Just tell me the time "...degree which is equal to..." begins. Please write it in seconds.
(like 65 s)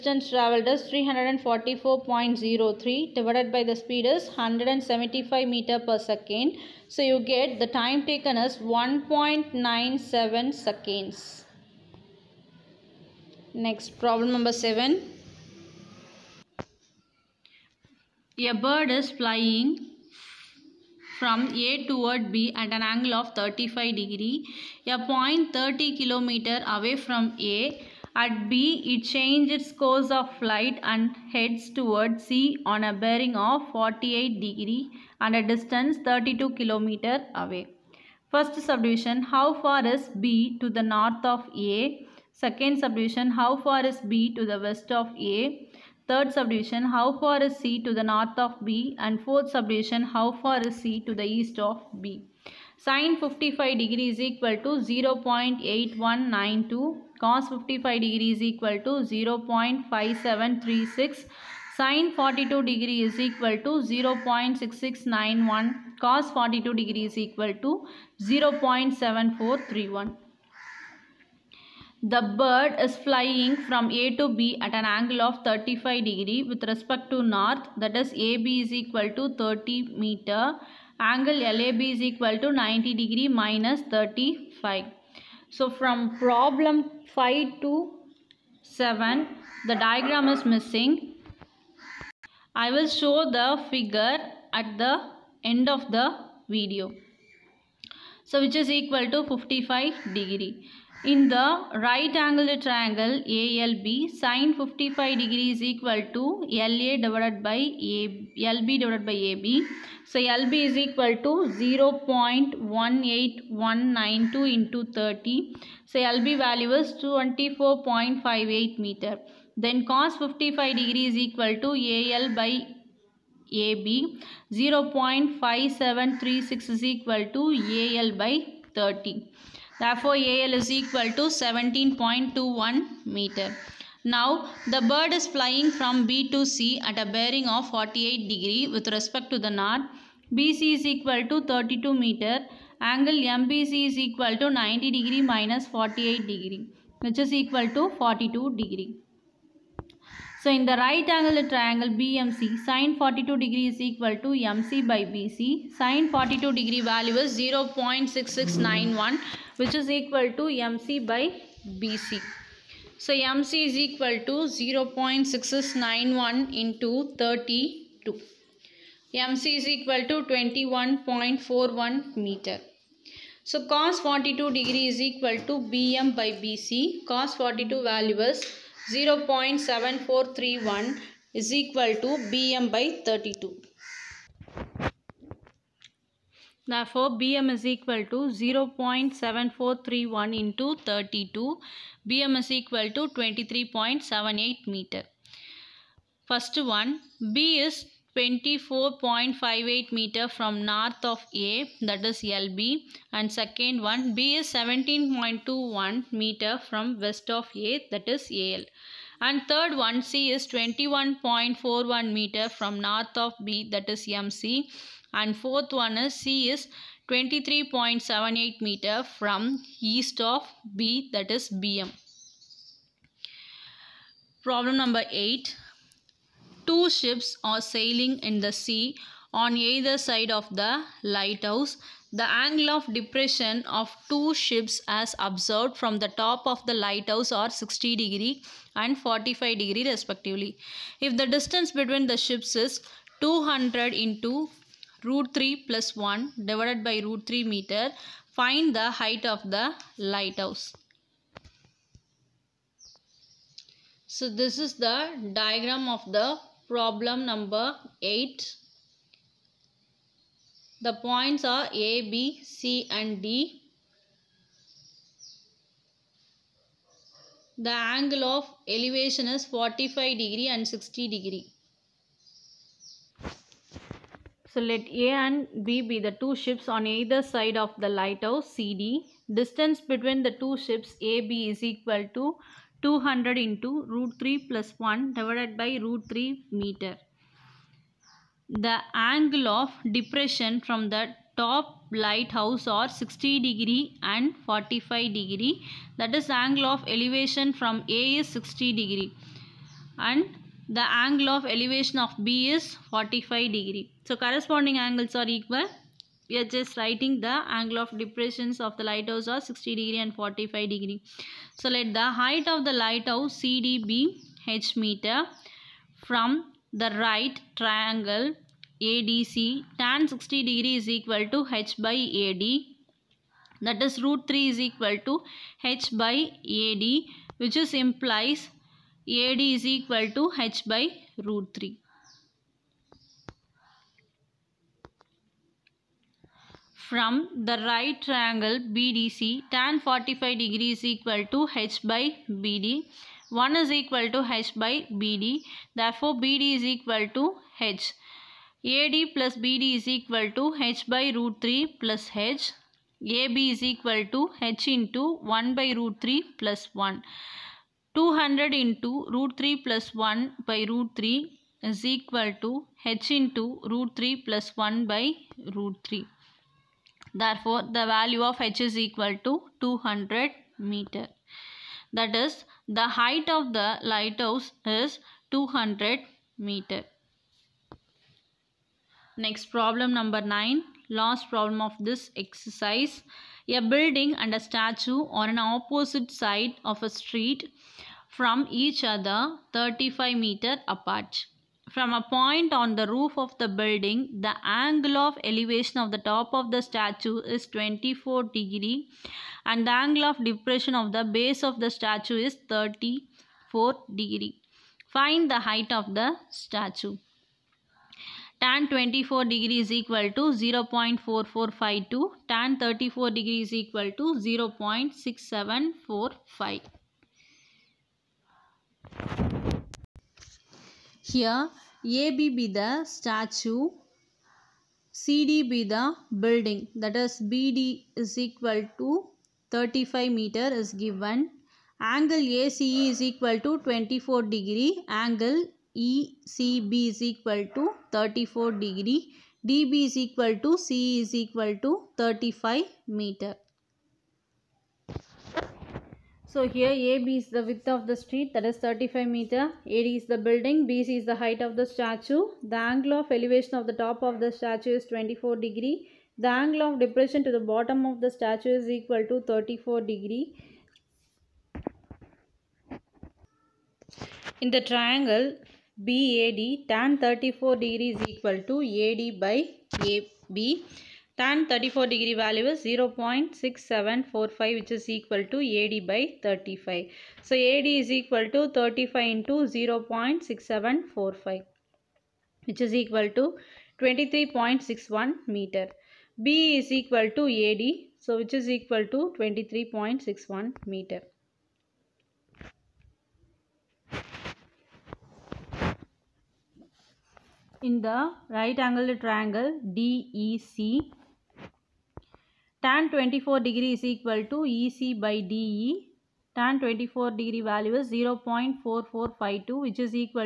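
146 s.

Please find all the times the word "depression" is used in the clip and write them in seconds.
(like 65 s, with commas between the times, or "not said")
232 s, 289 s, 307 s, 400 s, 456 s.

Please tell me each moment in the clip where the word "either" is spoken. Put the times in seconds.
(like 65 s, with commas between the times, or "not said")
229 s, 276 s.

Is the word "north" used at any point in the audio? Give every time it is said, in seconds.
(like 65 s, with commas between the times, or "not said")
40 s, 48 s, 77 s, 139 s, 200 s, 212 s.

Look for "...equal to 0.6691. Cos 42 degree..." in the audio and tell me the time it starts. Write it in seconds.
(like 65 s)
63 s.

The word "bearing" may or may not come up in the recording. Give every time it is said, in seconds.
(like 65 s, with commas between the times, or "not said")
32 s, 137 s.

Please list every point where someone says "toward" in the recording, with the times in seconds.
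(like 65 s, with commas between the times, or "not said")
21 s, 31 s.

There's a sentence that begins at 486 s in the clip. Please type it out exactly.
B is equal to AD so which is equal to 23.61 meter.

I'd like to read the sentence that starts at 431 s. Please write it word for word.
Angle ACE is equal to 24 degree.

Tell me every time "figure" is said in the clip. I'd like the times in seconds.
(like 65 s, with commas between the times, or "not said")
93 s.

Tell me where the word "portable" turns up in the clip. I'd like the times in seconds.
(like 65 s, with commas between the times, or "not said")
not said.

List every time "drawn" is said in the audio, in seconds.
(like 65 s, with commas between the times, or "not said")
not said.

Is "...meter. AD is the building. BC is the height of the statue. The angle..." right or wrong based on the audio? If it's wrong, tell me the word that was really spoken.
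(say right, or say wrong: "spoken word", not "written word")
right.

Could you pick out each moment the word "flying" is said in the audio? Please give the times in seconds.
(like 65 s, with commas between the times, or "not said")
19 s, 72 s, 135 s.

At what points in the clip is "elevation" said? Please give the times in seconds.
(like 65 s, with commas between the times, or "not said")
268 s, 296 s, 301 s, 395 s, 453 s.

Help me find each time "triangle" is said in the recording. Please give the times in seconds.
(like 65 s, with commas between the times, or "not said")
102 s, 151 s, 317 s, 338 s, 464 s, 499 s.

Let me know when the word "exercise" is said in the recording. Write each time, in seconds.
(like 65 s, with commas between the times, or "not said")
382 s.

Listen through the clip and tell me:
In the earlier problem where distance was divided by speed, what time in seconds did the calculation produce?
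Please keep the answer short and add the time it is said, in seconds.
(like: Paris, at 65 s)
1.97 seconds, at 8 s.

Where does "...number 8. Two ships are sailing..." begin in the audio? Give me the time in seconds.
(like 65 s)
224 s.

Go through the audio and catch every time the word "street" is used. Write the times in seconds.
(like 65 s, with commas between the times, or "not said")
386 s, 447 s.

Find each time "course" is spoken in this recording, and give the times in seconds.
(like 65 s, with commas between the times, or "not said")
29 s.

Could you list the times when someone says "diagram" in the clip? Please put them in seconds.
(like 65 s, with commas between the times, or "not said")
89 s, 255 s.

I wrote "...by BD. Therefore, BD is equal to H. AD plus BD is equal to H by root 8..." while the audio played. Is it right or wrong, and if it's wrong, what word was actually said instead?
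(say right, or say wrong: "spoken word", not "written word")
wrong: "3", not "8".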